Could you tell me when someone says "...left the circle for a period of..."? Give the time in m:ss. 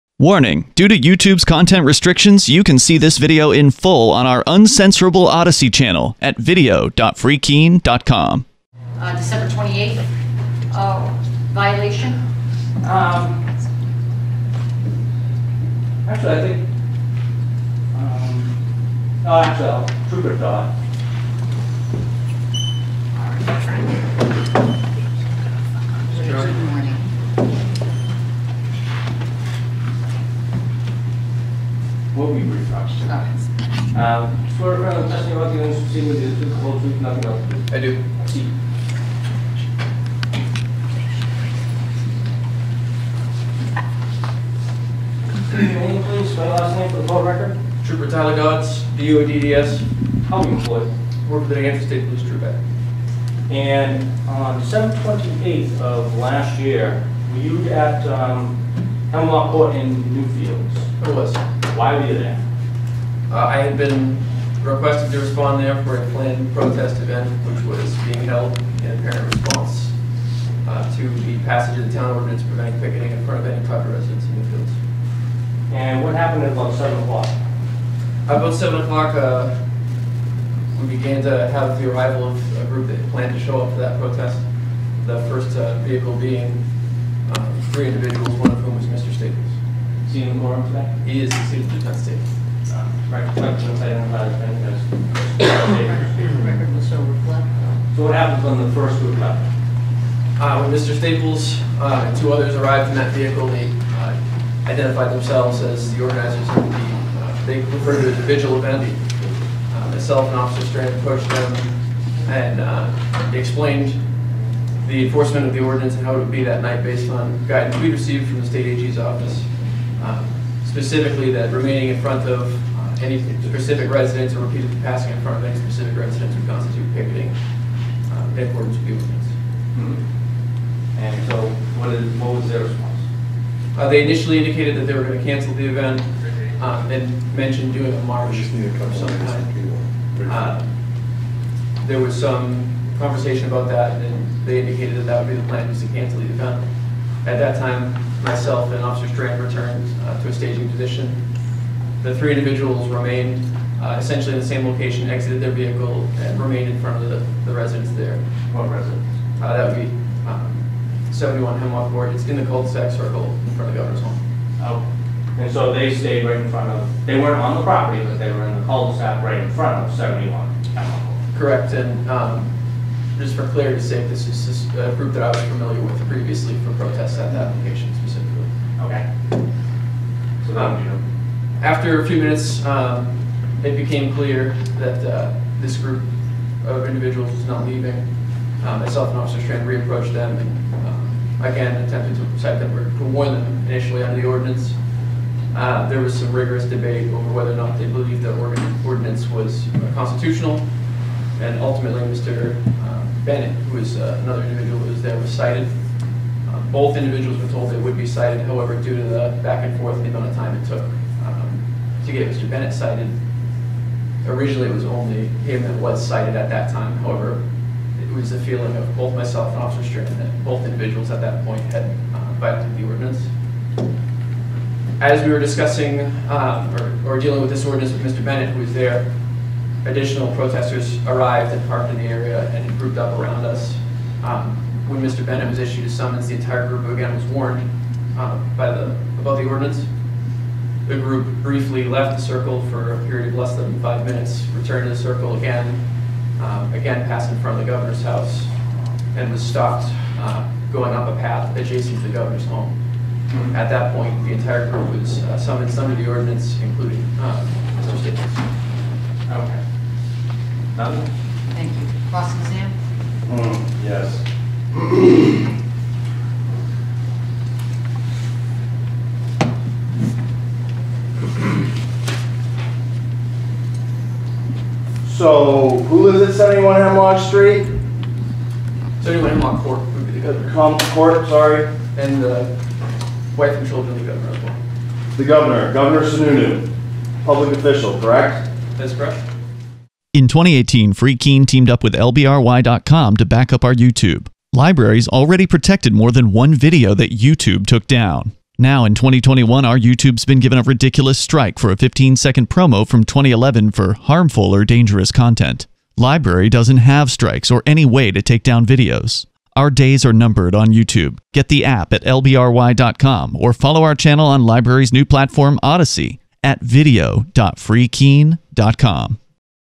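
4:01.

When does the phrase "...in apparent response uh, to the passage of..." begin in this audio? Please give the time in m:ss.
1:08.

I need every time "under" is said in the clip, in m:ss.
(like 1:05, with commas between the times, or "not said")
3:14, 4:15.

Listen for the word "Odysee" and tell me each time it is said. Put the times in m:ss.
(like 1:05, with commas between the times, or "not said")
0:05, 5:15.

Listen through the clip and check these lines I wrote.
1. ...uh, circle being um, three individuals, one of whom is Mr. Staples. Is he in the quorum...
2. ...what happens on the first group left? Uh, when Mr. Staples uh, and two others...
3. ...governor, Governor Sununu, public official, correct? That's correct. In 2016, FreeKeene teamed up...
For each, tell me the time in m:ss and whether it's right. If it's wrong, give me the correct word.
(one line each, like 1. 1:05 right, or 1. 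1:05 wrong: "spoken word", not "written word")
1. 1:25 wrong: "vehicle", not "circle"
2. 1:38 right
3. 4:45 wrong: "2018", not "2016".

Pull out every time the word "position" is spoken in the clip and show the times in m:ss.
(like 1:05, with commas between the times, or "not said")
2:30.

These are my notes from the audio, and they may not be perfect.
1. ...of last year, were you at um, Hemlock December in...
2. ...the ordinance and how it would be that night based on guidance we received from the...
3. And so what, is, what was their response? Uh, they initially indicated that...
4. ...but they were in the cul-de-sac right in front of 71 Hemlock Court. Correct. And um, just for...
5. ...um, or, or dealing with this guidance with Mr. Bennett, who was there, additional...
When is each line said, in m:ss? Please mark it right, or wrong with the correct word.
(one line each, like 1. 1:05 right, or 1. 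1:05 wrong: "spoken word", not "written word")
1. 0:55 wrong: "Court", not "December"
2. 1:55 right
3. 2:11 right
4. 2:48 right
5. 3:46 wrong: "ordinance", not "guidance".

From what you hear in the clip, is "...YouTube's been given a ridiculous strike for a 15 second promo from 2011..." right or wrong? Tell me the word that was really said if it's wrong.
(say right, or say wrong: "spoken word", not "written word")
right.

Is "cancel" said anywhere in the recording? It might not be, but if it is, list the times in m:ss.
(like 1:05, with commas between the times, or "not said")
2:15, 2:25.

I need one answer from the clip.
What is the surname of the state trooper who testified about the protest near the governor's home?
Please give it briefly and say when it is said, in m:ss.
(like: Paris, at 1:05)
Dodds, at 0:47.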